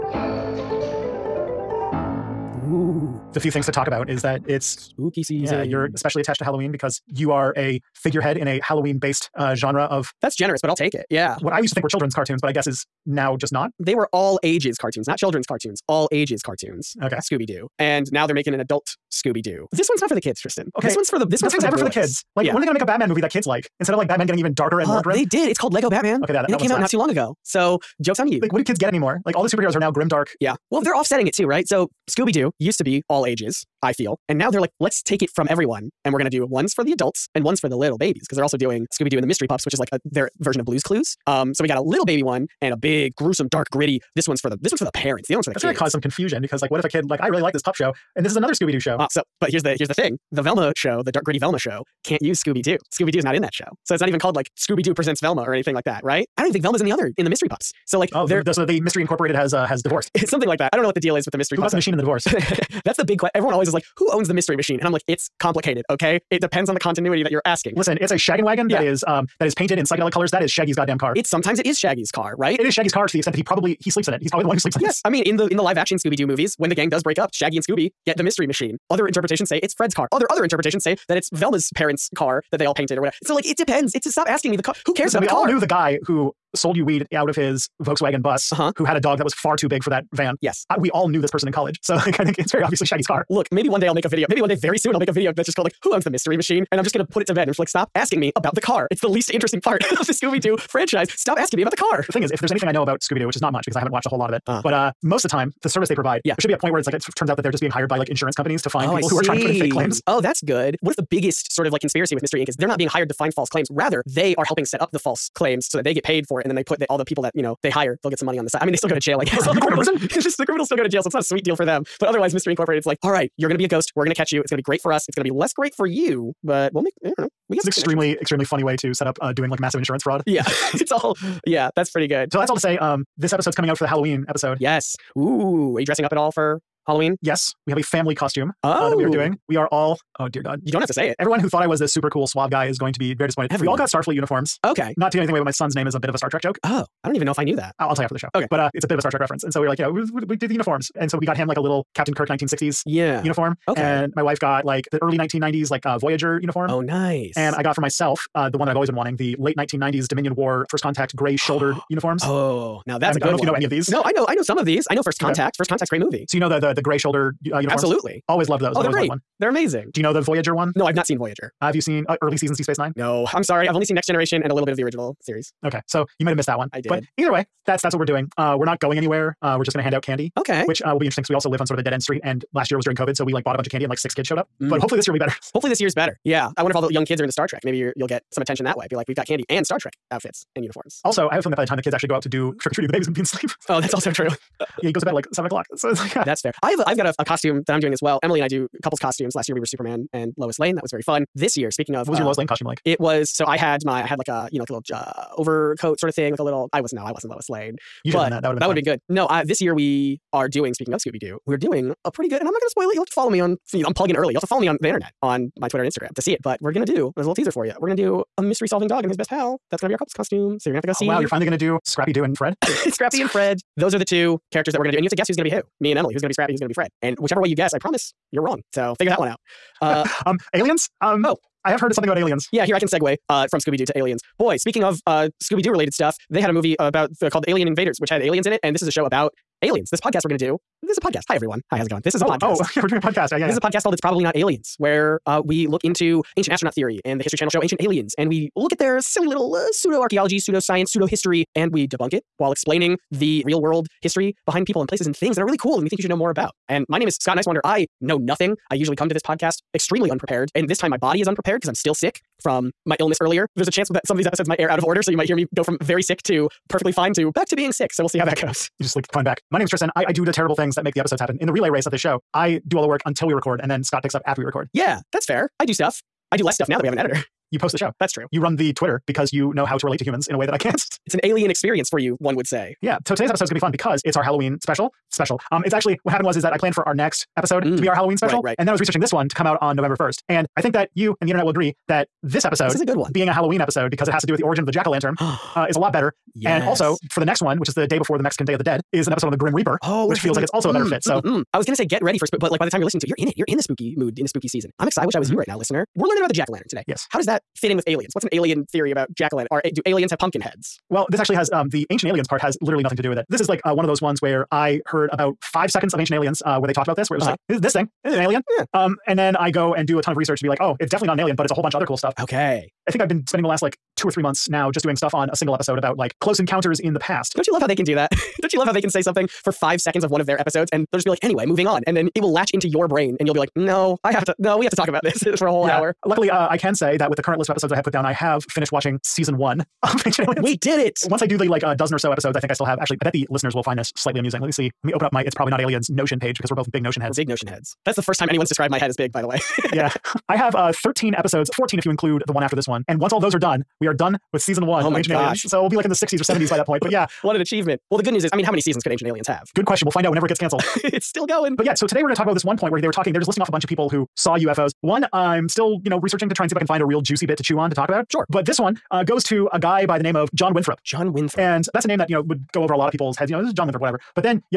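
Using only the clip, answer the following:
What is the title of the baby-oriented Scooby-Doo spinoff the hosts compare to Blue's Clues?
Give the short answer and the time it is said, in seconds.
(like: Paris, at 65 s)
Scooby Doo and the Mystery Pups, at 38 s.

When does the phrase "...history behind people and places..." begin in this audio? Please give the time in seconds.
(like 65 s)
254 s.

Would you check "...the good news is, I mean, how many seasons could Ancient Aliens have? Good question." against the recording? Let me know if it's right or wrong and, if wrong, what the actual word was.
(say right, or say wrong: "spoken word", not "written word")
right.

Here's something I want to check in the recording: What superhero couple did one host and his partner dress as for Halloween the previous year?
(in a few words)
Superman and Lois Lane.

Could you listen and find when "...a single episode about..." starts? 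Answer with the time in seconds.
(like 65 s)
325 s.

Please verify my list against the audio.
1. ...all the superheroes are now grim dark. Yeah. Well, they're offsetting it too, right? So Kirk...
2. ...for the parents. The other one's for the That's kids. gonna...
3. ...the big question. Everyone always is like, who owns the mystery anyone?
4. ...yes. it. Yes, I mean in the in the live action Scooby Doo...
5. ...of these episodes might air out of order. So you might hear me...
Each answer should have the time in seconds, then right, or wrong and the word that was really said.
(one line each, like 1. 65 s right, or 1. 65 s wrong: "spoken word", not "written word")
1. 29 s wrong: "Scooby", not "Kirk"
2. 44 s right
3. 62 s wrong: "machine", not "anyone"
4. 74 s right
5. 264 s right.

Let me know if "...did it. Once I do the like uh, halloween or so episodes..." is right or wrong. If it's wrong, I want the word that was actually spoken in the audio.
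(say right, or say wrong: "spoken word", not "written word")
wrong: "dozen", not "halloween".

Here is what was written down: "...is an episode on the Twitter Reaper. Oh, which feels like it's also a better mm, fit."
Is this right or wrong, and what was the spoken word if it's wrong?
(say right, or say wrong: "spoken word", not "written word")
wrong: "Grim", not "Twitter".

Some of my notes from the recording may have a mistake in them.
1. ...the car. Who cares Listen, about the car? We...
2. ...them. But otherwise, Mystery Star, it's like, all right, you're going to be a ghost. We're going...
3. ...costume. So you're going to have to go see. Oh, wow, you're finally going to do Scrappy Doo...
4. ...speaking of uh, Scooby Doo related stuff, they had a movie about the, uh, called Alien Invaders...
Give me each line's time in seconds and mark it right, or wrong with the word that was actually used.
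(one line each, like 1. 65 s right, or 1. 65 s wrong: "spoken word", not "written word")
1. 84 s right
2. 121 s wrong: "Incorporated", not "Star"
3. 220 s right
4. 234 s right.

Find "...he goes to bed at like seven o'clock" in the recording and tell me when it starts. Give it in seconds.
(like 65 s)
194 s.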